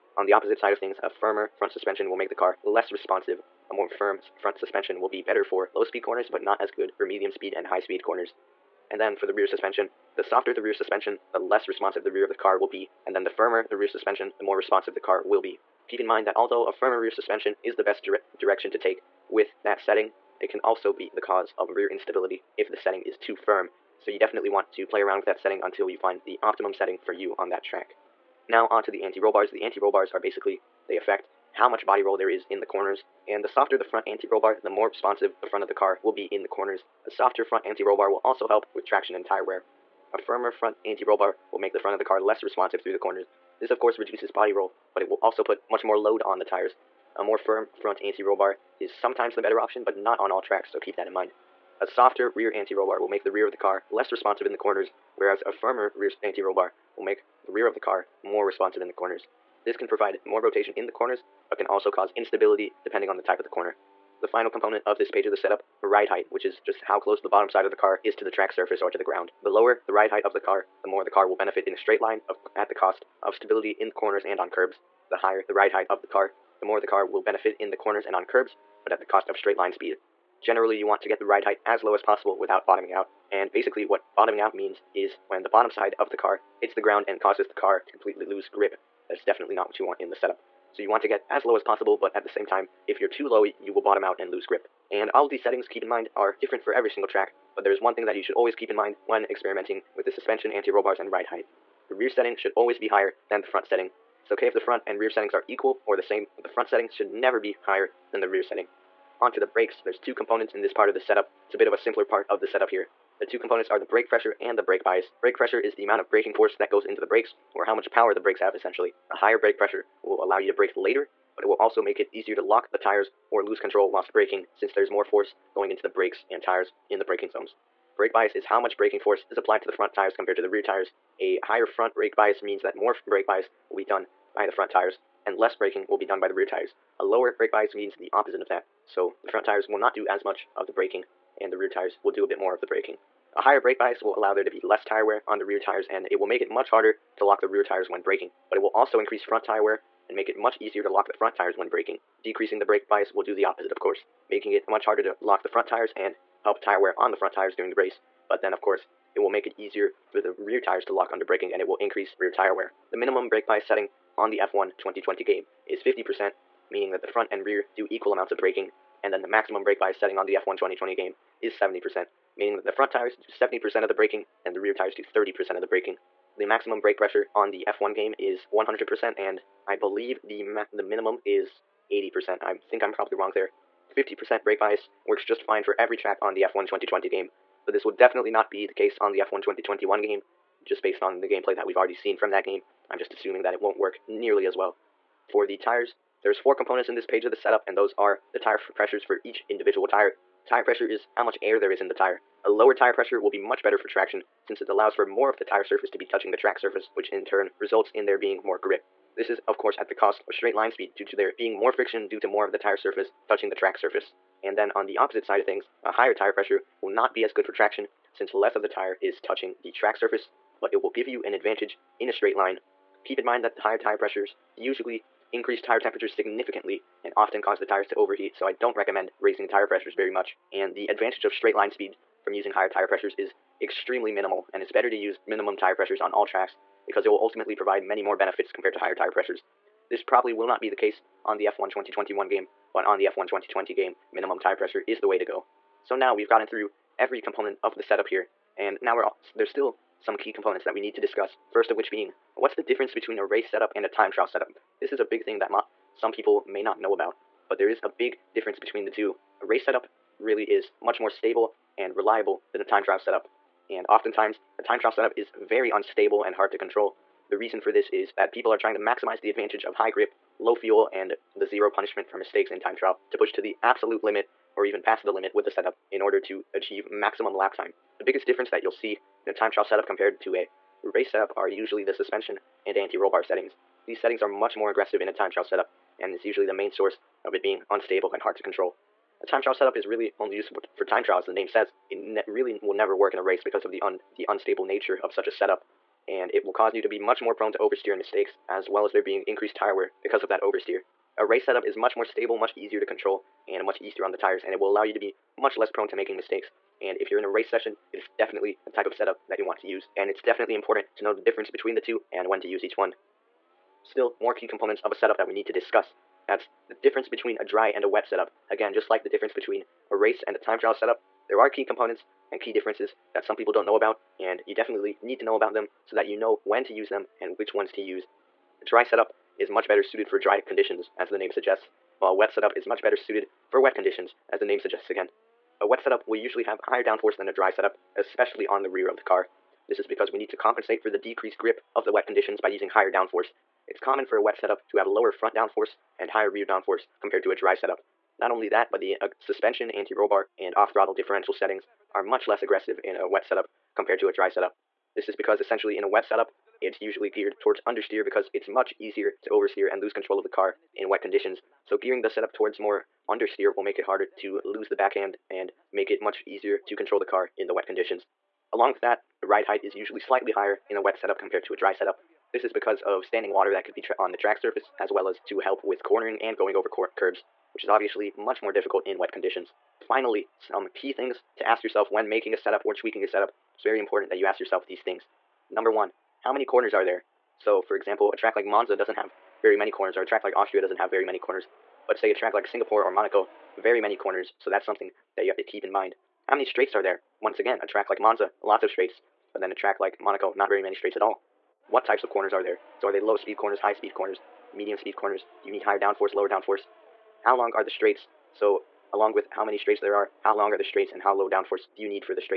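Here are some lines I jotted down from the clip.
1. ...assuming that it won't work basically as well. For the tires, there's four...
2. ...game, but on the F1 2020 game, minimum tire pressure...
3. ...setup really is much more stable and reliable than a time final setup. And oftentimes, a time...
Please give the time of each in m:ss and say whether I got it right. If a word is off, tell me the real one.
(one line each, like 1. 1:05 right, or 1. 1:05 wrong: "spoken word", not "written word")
1. 3:13 wrong: "nearly", not "basically"
2. 4:02 right
3. 4:19 wrong: "trial", not "final".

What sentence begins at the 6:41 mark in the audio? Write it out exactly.
What types of corners are there?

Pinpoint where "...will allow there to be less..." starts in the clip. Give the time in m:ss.
2:24.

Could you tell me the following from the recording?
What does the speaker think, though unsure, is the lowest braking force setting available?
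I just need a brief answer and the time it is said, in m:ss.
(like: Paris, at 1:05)
80%, at 3:01.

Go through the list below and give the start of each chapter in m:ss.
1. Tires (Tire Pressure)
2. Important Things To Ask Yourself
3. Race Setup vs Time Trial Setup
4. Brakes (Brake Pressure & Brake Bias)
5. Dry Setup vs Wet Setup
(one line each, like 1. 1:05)
1. 3:15
2. 6:19
3. 4:05
4. 1:49
5. 5:13.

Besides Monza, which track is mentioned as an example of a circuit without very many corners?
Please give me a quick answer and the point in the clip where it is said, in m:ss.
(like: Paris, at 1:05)
Austria, at 6:30.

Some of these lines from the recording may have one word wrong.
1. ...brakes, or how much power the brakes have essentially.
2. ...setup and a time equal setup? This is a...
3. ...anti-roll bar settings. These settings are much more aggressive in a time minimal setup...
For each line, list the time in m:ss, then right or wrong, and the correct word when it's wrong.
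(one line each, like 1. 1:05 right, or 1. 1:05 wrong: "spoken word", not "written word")
1. 1:57 right
2. 4:13 wrong: "trial", not "equal"
3. 4:42 wrong: "trial", not "minimal".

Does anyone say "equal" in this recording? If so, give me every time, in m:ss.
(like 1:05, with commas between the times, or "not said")
1:45, 2:47.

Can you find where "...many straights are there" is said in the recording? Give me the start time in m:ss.
6:36.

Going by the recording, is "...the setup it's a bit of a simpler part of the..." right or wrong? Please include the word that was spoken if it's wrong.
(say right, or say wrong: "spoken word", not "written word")
right.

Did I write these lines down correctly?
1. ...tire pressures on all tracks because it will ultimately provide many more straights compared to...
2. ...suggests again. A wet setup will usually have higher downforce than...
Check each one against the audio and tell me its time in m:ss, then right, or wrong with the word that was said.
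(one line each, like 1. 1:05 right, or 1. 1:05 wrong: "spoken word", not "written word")
1. 3:55 wrong: "benefits", not "straights"
2. 5:34 right.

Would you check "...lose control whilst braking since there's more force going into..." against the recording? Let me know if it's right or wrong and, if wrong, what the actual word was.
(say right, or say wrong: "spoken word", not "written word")
right.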